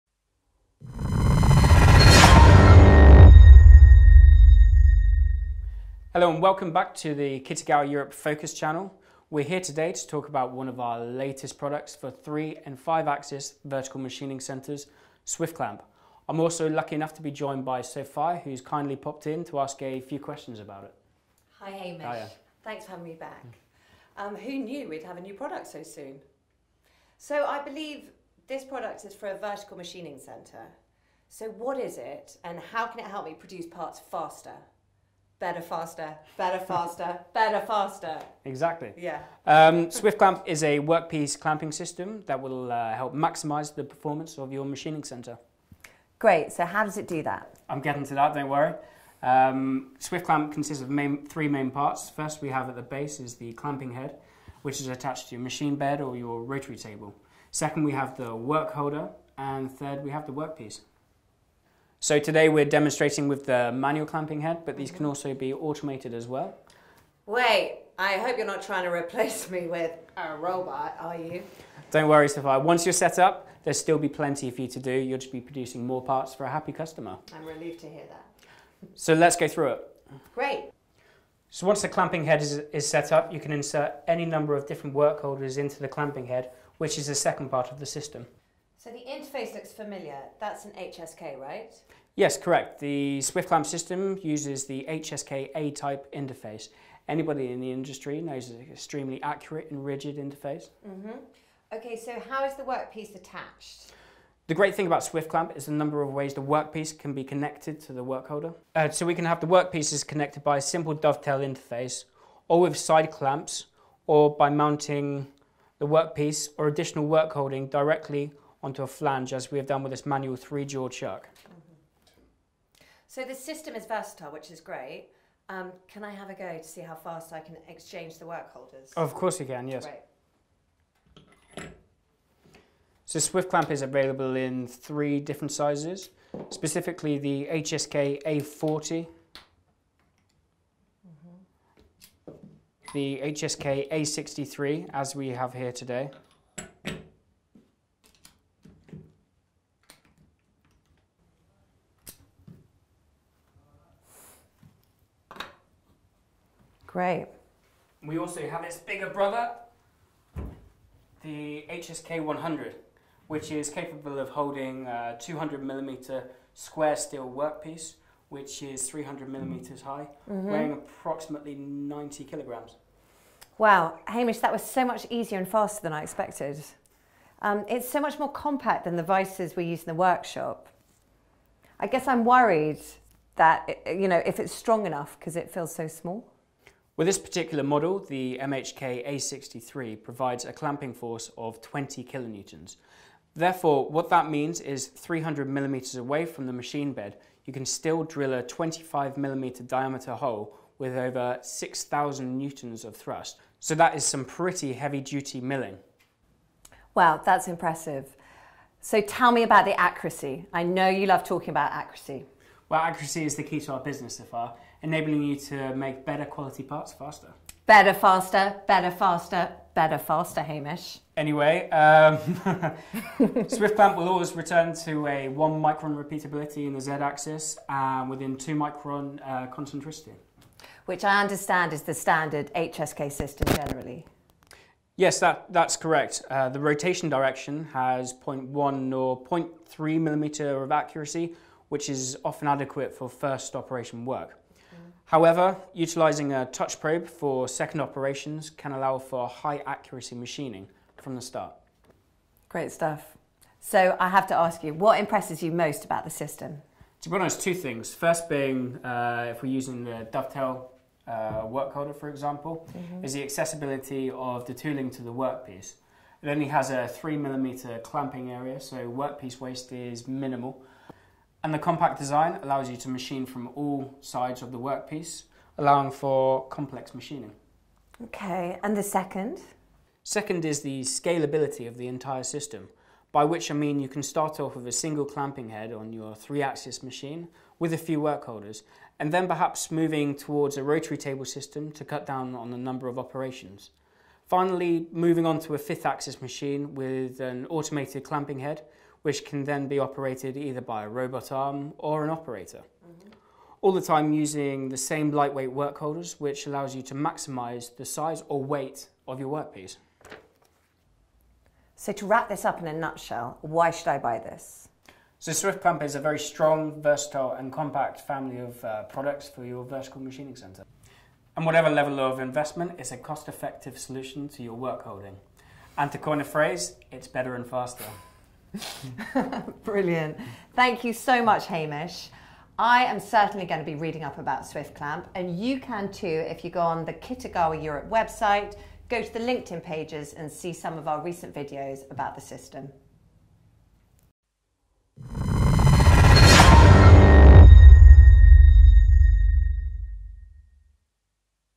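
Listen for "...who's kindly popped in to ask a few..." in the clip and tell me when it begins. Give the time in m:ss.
0:18.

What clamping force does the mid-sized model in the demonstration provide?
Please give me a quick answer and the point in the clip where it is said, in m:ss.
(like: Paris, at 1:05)
20 kilonewtons, at 3:11.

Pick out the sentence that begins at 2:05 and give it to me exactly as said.
Um, can I have a go to see how fast I can exchange the work holders?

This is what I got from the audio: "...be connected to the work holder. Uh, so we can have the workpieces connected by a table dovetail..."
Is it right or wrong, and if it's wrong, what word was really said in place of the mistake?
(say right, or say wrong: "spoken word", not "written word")
wrong: "simple", not "table".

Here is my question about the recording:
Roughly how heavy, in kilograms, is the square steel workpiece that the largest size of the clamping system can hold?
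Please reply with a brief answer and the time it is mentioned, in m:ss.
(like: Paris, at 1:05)
90 kilograms, at 2:51.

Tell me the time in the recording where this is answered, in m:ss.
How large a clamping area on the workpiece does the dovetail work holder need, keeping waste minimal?
4:26.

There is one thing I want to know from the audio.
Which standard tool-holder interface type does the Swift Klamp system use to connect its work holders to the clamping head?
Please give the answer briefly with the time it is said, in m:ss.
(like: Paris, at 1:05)
HSK A-type, at 1:34.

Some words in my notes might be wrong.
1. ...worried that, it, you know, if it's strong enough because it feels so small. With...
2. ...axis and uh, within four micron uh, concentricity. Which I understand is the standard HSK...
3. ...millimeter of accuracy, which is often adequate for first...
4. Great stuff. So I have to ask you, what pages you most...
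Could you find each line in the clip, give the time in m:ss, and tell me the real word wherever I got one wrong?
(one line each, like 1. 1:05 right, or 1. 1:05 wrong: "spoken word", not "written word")
1. 3:02 right
2. 3:46 wrong: "two", not "four"
3. 4:00 right
4. 4:12 wrong: "impresses", not "pages".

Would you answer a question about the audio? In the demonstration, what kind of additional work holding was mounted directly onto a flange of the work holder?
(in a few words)
manual three jaw chuck.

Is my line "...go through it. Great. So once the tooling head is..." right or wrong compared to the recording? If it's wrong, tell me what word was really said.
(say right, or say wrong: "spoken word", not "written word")
wrong: "clamping", not "tooling".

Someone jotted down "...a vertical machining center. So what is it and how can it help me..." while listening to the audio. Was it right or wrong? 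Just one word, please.
right.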